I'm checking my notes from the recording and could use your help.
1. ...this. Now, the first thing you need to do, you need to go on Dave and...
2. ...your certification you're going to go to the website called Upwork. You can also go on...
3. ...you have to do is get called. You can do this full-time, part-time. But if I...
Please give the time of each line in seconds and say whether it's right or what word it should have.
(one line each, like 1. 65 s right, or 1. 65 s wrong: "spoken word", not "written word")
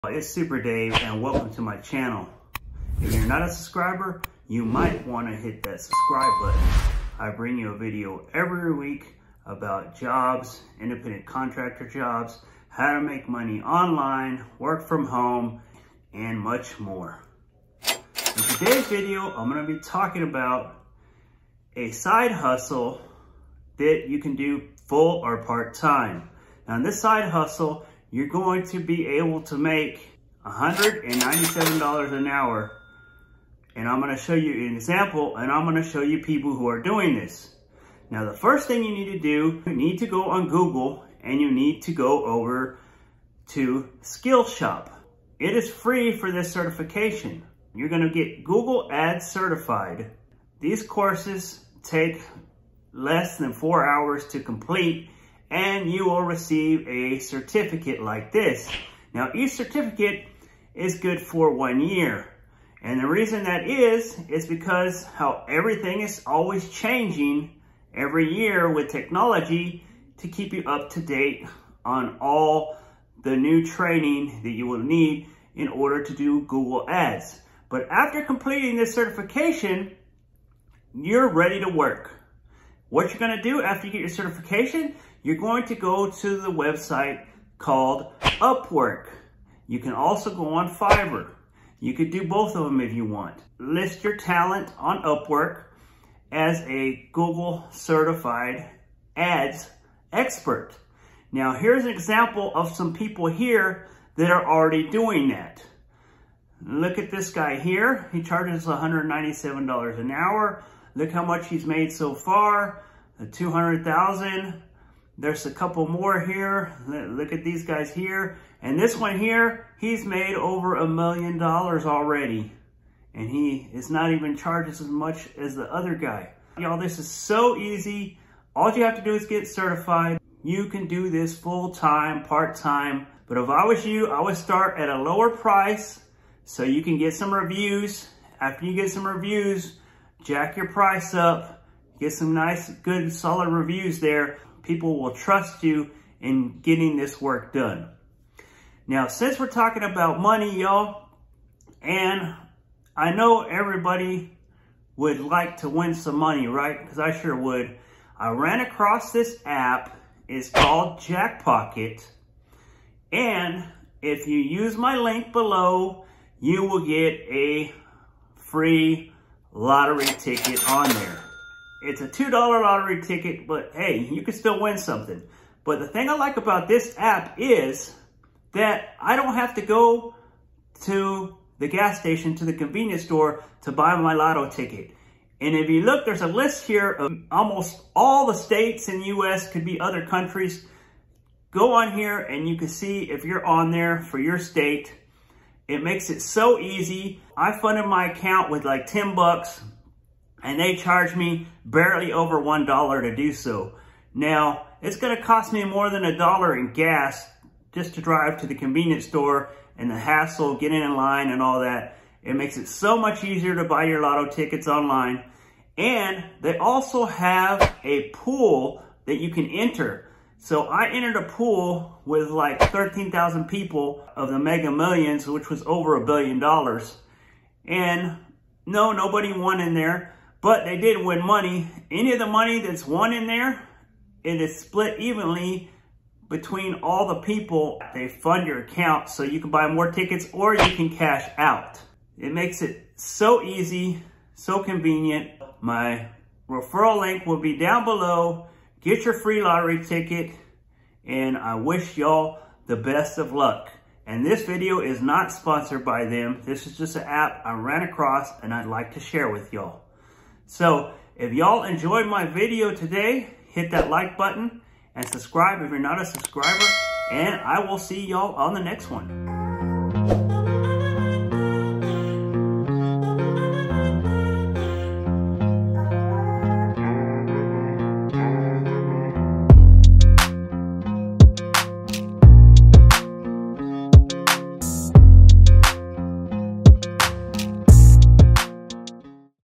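1. 37 s wrong: "Google", not "Dave"
2. 83 s right
3. 128 s wrong: "certified", not "called".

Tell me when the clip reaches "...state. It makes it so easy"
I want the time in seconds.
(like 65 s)
194 s.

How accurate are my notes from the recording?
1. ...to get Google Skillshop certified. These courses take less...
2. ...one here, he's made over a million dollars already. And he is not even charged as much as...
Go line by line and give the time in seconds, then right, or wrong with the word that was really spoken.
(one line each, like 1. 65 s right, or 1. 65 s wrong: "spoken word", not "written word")
1. 48 s wrong: "Ads", not "Skillshop"
2. 118 s right.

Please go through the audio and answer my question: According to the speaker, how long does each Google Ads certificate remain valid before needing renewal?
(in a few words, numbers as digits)
1 year.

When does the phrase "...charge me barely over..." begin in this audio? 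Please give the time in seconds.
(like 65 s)
200 s.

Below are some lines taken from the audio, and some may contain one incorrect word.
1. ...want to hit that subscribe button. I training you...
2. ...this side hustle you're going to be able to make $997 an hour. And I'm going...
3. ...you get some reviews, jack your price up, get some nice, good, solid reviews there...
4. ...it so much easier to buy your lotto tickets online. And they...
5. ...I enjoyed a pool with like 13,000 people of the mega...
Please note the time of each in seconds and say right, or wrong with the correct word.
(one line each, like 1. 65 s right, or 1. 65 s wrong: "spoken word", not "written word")
1. 5 s wrong: "bring", not "training"
2. 26 s wrong: "197", not "997"
3. 138 s right
4. 212 s right
5. 220 s wrong: "entered", not "enjoyed".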